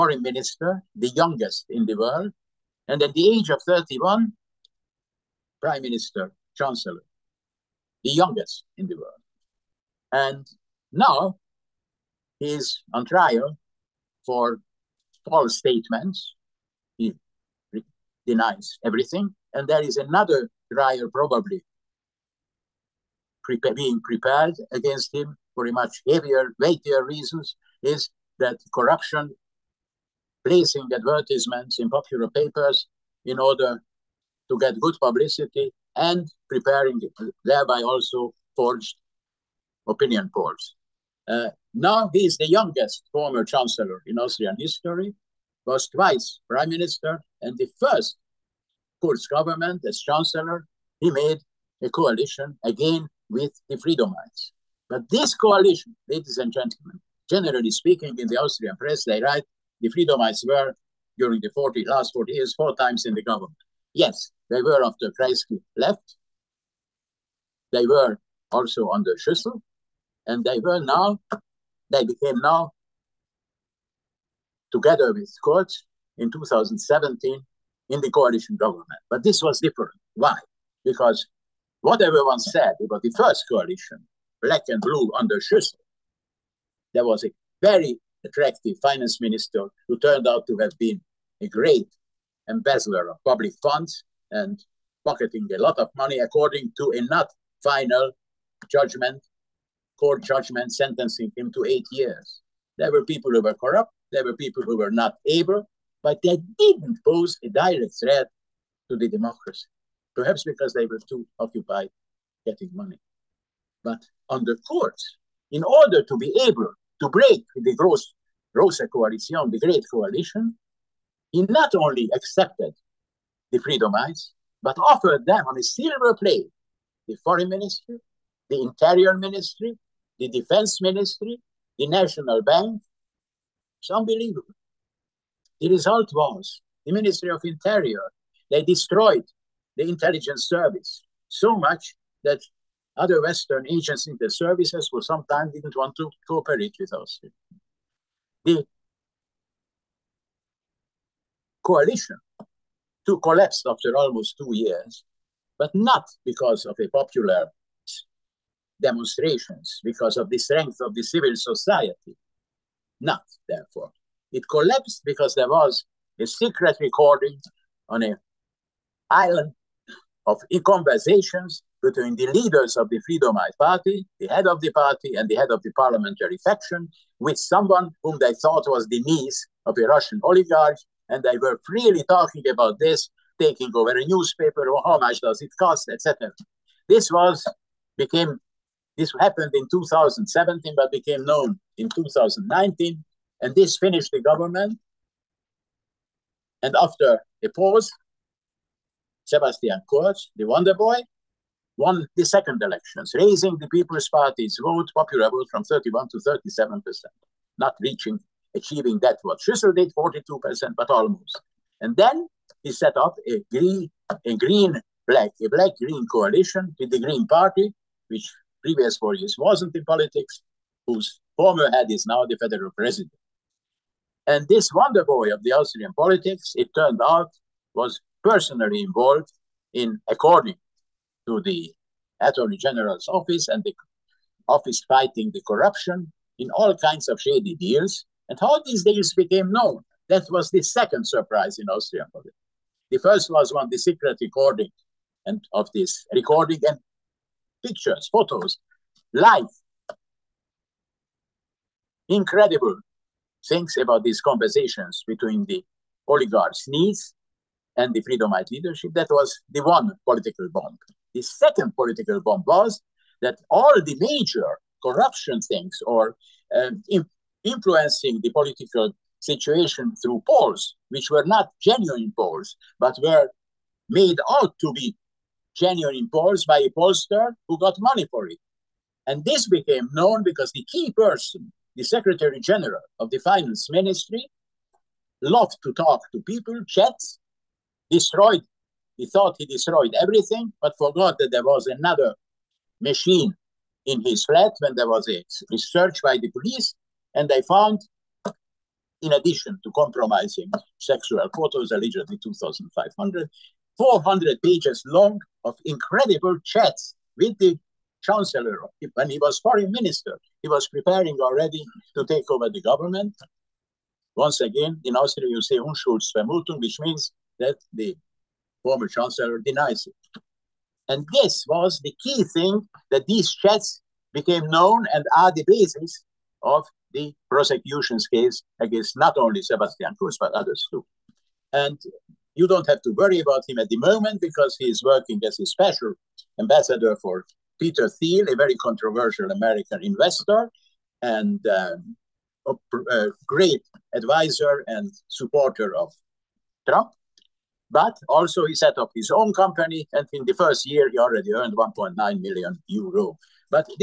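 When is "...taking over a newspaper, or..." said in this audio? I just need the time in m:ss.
3:03.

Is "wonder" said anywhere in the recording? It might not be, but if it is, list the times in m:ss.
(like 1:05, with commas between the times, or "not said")
3:20, 3:44.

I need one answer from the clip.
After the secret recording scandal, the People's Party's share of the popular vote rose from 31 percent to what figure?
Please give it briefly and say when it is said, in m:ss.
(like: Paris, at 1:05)
37 percent, at 3:26.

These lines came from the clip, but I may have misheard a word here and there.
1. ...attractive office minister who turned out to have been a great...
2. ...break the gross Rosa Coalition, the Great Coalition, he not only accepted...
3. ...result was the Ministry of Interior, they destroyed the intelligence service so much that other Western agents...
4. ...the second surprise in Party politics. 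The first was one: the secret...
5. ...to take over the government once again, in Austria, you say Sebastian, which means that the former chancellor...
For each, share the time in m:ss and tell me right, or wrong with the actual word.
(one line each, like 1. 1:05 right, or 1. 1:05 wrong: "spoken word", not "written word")
1. 1:28 wrong: "finance", not "office"
2. 1:57 right
3. 2:15 right
4. 4:00 wrong: "Austrian", not "Party"
5. 5:11 wrong: "Unschuldsvermutung", not "Sebastian".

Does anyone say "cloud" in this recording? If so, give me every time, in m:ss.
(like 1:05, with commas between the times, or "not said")
not said.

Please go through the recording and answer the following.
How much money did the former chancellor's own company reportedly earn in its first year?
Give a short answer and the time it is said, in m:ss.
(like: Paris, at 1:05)
1.9 million euros, at 5:51.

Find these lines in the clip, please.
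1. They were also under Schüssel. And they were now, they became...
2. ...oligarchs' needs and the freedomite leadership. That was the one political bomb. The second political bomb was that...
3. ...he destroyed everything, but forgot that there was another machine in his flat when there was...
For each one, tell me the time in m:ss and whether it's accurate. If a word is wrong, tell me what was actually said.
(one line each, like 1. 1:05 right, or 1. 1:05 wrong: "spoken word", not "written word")
1. 1:07 right
2. 4:16 right
3. 4:49 right.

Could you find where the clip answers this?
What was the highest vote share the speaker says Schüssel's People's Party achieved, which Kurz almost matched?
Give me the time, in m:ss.
3:29.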